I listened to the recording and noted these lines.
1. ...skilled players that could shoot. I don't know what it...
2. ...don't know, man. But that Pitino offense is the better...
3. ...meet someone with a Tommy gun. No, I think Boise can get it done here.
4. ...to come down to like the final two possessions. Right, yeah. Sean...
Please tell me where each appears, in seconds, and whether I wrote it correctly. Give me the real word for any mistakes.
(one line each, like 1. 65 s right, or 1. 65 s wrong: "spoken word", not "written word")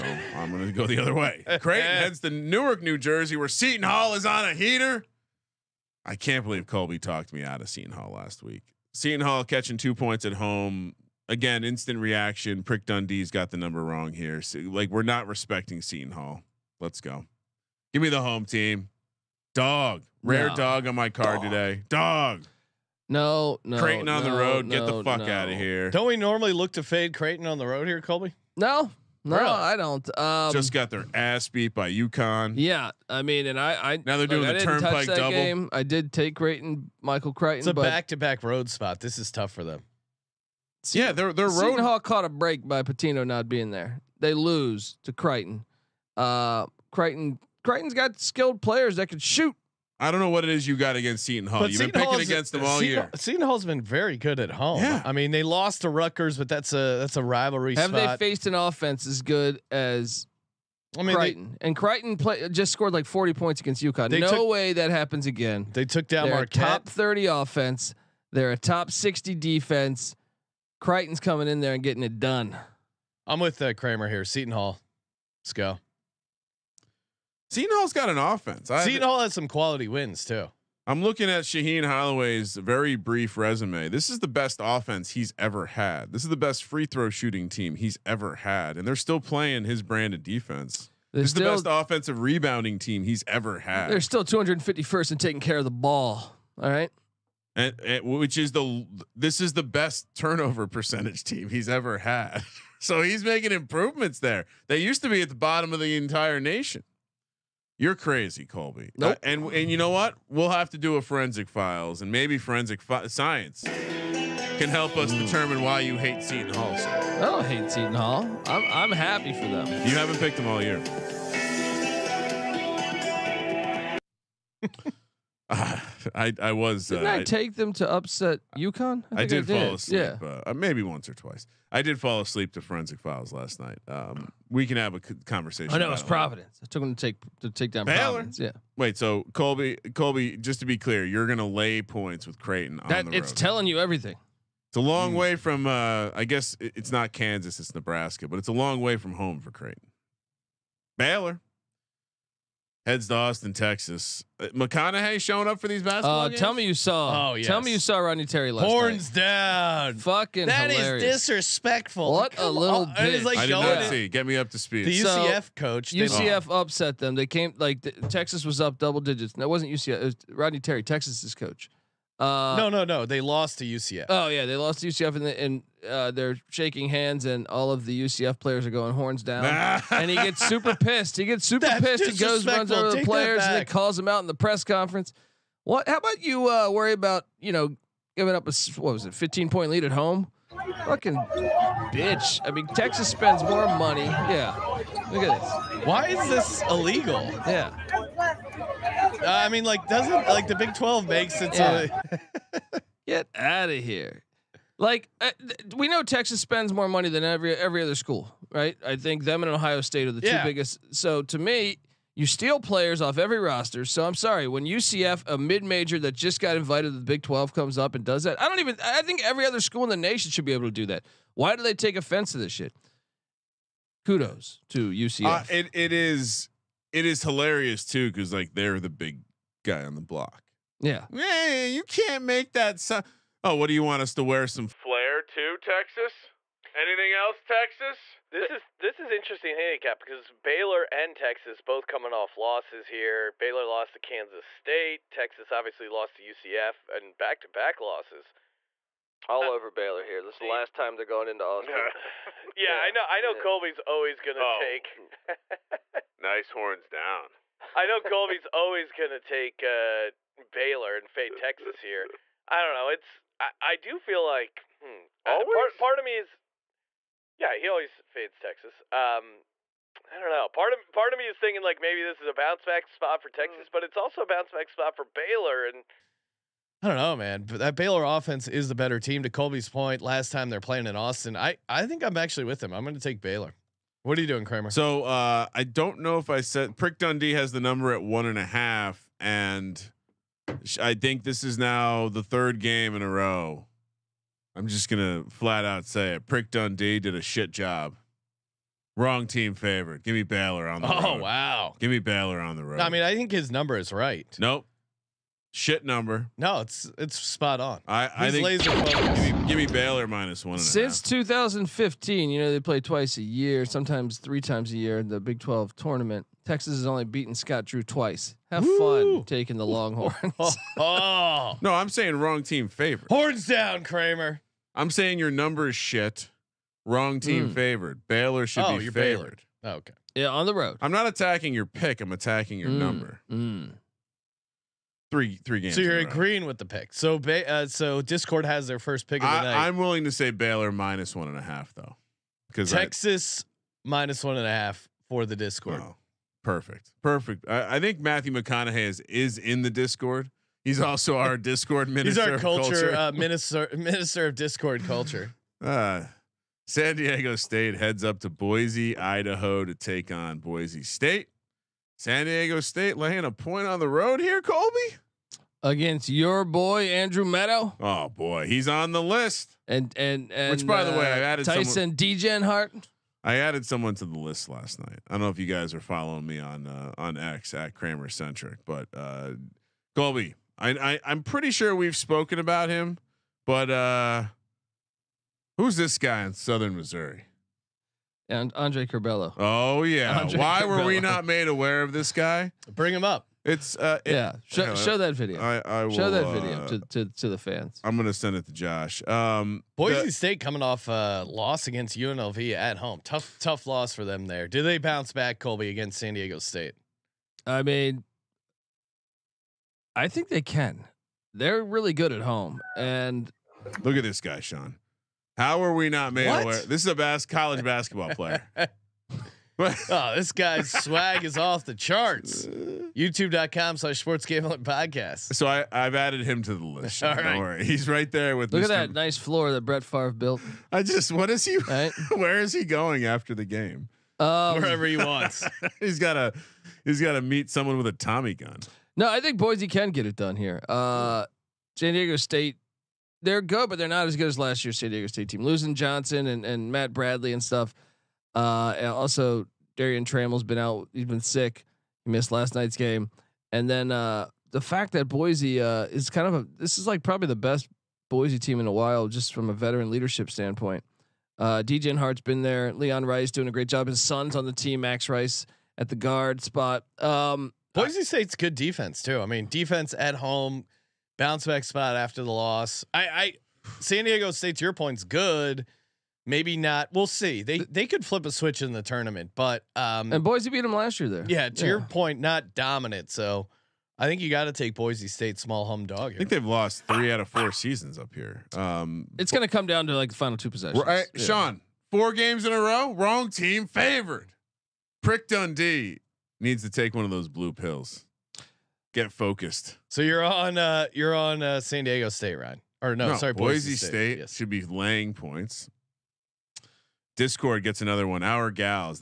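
1. 48 s right
2. 276 s wrong: "Baylor", not "Pitino"
3. 437 s right
4. 489 s right.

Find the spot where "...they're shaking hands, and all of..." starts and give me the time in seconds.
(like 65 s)
176 s.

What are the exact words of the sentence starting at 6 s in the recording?
I can't believe Colby talked me out of Seton Hall last week.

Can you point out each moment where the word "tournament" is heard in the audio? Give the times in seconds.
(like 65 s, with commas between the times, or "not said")
315 s, 478 s.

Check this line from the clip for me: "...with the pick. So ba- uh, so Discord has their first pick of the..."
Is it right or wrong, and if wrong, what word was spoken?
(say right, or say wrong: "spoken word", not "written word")
right.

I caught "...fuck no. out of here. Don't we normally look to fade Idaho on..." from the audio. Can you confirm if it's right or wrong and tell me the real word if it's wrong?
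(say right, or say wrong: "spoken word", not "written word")
wrong: "Creighton", not "Idaho".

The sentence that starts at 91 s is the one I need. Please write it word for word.
They're this is the best offensive rebounding team he's ever had.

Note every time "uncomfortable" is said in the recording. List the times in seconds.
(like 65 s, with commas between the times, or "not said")
not said.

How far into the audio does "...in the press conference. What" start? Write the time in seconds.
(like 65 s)
184 s.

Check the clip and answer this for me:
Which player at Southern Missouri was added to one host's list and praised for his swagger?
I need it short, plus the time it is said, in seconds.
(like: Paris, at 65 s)
Andre Curbelo, at 388 s.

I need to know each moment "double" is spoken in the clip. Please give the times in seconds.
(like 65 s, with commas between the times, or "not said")
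35 s, 168 s.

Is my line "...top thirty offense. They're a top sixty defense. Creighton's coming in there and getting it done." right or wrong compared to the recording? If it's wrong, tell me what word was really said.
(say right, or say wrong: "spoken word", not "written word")
right.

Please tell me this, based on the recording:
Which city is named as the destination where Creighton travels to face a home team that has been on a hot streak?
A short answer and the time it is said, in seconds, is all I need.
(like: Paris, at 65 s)
Newark, New Jersey, at 2 s.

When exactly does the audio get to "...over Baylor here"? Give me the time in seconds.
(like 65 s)
249 s.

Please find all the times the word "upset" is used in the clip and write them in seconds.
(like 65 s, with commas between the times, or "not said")
127 s, 166 s.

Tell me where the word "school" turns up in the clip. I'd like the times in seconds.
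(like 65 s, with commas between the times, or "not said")
207 s, 219 s.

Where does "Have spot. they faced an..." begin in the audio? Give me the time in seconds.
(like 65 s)
57 s.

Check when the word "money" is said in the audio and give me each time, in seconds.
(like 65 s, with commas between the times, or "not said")
193 s, 206 s.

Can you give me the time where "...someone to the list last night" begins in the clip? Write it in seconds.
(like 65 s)
373 s.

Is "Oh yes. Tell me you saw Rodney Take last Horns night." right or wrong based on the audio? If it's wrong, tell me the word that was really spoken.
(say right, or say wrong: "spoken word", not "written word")
wrong: "Terry", not "Take".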